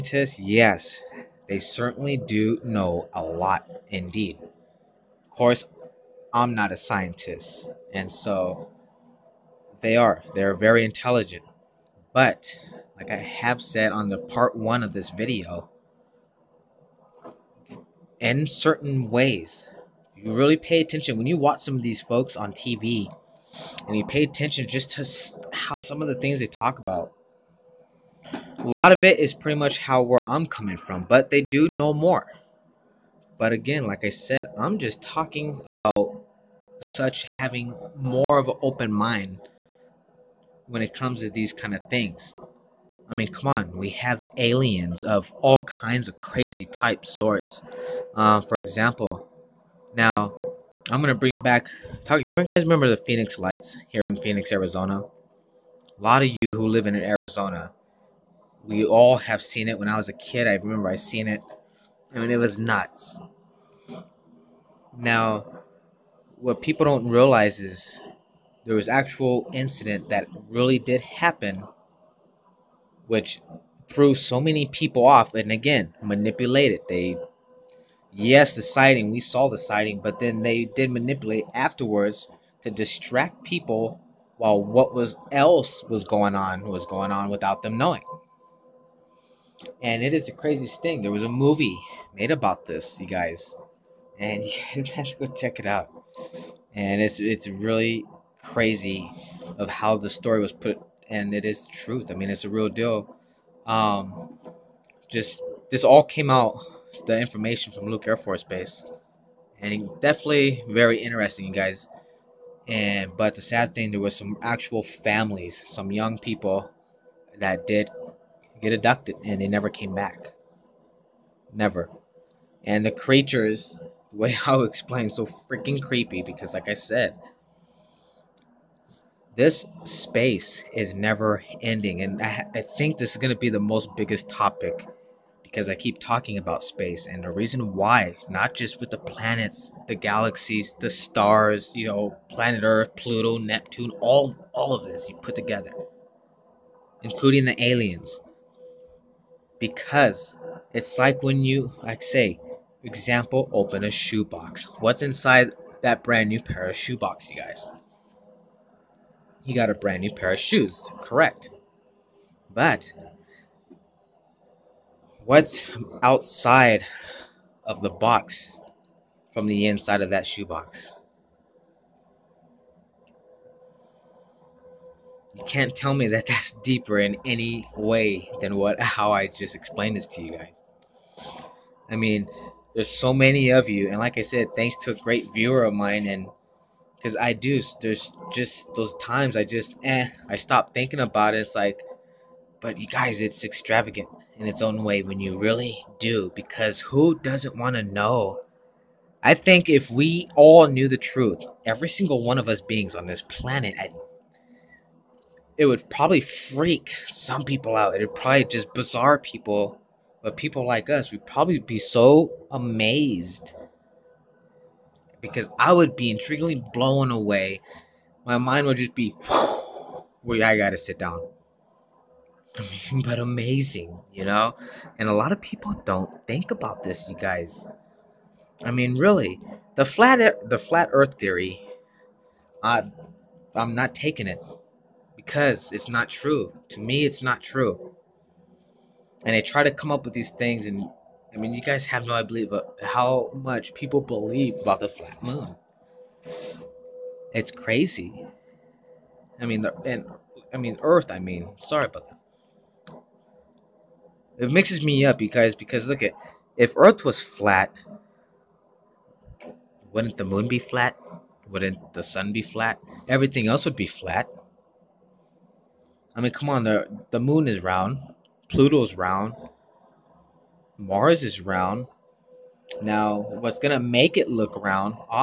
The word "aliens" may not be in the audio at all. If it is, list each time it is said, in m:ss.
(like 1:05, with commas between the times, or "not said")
0:44, 2:27.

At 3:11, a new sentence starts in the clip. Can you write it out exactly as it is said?
It's like, but you guys, it's extravagant in its own way when you really do, because who doesn't want to know?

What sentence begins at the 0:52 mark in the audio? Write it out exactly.
Talk, you guys remember the Phoenix Lights here in Phoenix, Arizona?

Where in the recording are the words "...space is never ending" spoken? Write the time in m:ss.
2:09.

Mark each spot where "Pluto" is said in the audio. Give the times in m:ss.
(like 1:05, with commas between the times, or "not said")
2:22, 4:28.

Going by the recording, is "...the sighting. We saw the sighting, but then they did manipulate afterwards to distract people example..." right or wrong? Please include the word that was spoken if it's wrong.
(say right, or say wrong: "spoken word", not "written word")
wrong: "while", not "example".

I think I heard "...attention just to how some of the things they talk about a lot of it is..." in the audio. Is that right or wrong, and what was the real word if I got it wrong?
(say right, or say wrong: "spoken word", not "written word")
right.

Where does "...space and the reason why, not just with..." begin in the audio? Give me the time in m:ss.
2:16.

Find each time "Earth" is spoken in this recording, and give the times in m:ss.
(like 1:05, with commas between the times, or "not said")
2:22, 3:50, 4:10, 4:16.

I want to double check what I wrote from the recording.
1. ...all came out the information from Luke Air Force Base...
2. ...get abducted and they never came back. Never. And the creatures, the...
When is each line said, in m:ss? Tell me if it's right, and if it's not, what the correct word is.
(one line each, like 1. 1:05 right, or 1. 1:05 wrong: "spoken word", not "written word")
1. 1:45 right
2. 1:58 right.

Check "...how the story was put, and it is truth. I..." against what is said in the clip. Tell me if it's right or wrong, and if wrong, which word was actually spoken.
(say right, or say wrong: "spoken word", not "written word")
right.